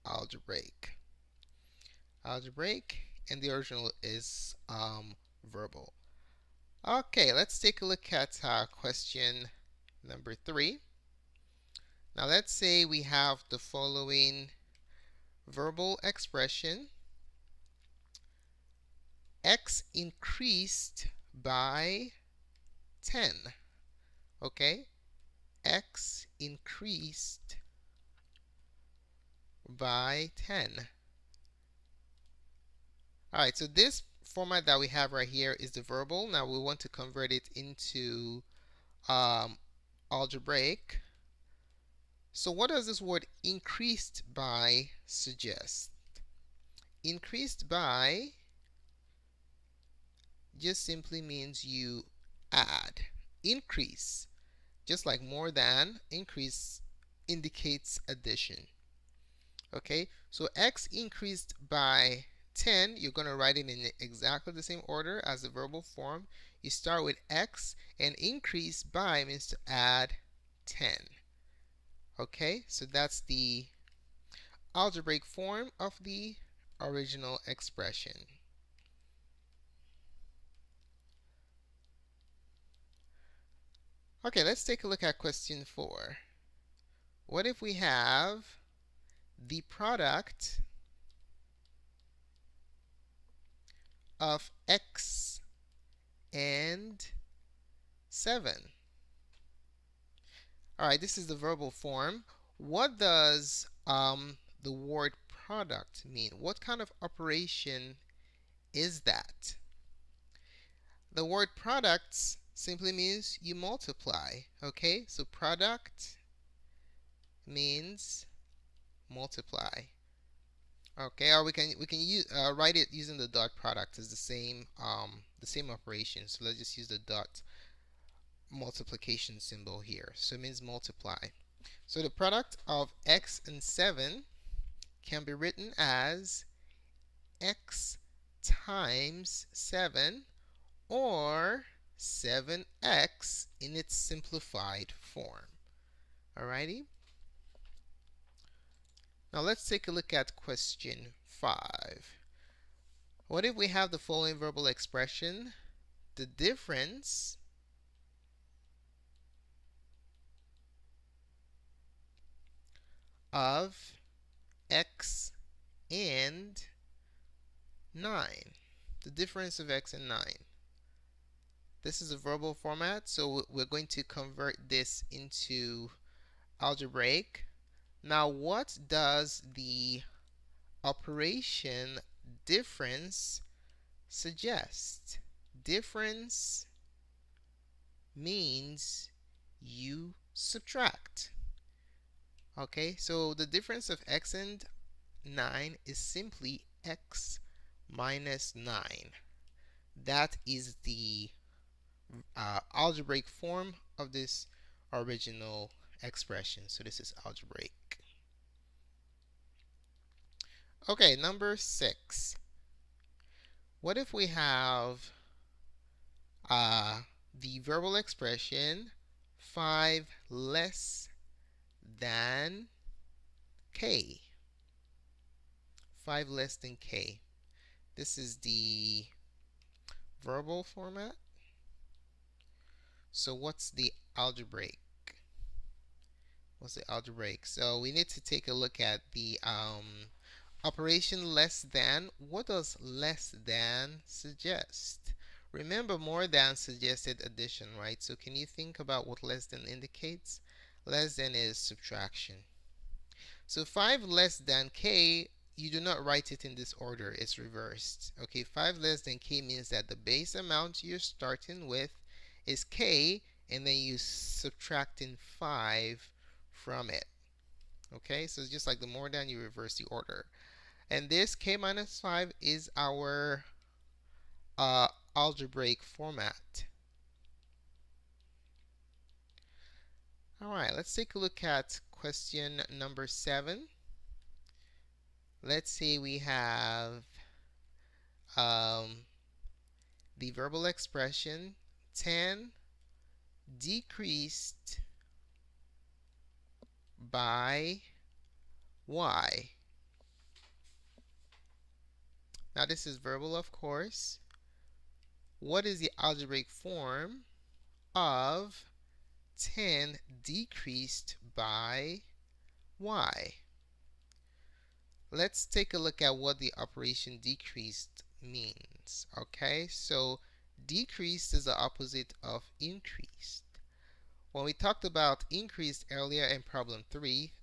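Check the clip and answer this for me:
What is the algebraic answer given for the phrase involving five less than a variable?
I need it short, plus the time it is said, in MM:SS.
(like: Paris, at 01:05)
k - 5, at 04:31.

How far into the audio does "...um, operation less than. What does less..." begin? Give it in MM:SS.
03:59.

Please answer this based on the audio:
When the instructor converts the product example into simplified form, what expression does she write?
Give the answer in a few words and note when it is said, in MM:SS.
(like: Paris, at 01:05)
7x, at 02:21.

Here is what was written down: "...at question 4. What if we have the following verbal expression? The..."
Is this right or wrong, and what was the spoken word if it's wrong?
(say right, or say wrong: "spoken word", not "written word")
wrong: "5", not "4".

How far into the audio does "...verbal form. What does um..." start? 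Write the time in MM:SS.
01:41.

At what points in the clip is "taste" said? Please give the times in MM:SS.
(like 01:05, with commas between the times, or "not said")
not said.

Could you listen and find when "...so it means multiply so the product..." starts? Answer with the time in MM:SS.
02:10.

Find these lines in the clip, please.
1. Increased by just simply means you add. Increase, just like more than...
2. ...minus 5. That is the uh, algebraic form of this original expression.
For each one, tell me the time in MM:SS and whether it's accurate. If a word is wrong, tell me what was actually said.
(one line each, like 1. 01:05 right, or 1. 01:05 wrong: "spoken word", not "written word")
1. 00:47 right
2. 03:17 wrong: "9", not "5".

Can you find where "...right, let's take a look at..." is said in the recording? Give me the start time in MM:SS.
04:40.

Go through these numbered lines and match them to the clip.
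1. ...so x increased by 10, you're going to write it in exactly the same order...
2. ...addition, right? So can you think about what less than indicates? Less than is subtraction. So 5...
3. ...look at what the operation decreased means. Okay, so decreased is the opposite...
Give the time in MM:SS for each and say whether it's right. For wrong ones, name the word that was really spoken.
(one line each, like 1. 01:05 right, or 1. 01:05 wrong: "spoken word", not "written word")
1. 01:00 right
2. 04:07 right
3. 05:15 right.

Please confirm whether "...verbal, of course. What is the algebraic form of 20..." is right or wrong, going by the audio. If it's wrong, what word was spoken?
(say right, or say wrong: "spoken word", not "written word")
wrong: "10", not "20".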